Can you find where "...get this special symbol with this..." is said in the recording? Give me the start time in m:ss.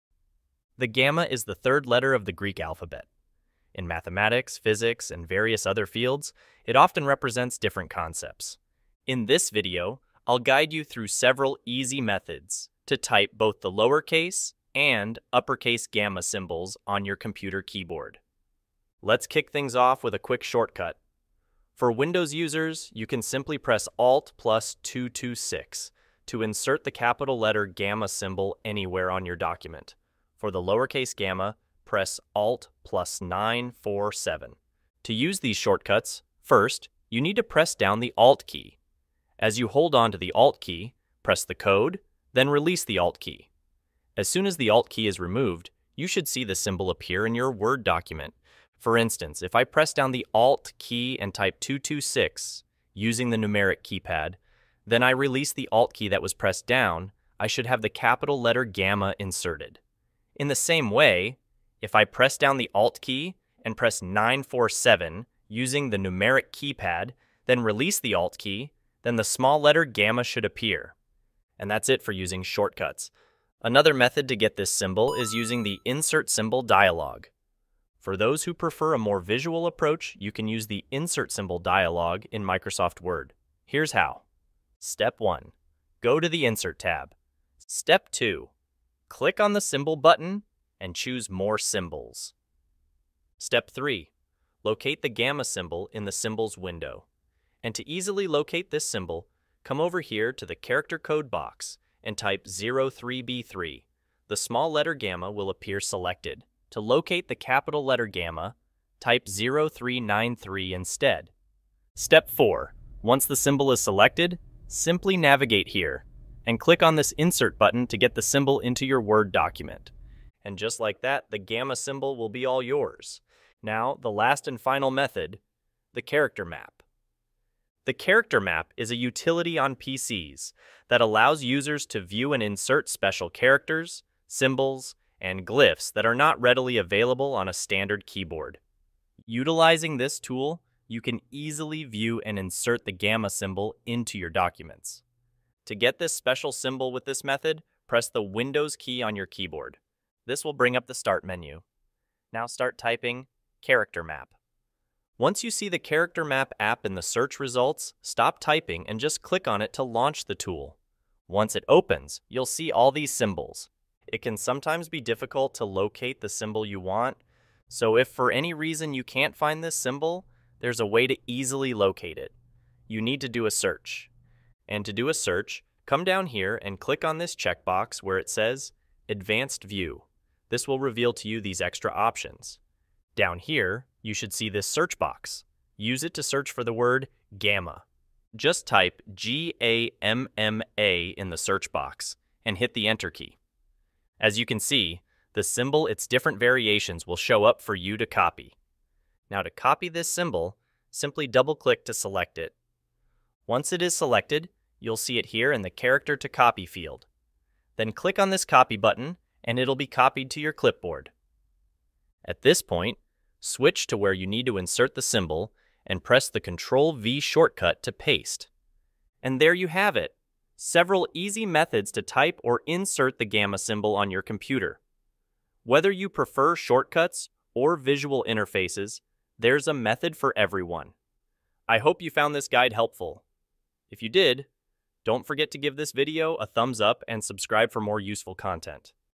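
2:25.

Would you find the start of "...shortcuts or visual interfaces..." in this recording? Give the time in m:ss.
3:46.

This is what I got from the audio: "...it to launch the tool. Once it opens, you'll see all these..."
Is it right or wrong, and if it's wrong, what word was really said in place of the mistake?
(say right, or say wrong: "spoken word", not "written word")
right.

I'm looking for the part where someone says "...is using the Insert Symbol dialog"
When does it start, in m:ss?
1:15.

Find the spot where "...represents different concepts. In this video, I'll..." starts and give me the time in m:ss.
0:07.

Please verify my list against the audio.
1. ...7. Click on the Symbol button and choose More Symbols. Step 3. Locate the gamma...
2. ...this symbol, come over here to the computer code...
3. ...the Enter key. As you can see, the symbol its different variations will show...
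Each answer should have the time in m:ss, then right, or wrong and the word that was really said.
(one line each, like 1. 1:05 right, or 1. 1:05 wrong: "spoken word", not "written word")
1. 1:28 wrong: "2", not "7"
2. 1:38 wrong: "character", not "computer"
3. 3:12 right.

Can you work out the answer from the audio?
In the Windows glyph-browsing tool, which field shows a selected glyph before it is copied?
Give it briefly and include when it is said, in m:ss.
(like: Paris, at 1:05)
Character to Copy, at 3:25.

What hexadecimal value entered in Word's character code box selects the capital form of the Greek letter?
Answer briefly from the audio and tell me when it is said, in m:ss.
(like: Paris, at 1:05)
0393, at 1:49.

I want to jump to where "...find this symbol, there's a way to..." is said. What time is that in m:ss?
2:49.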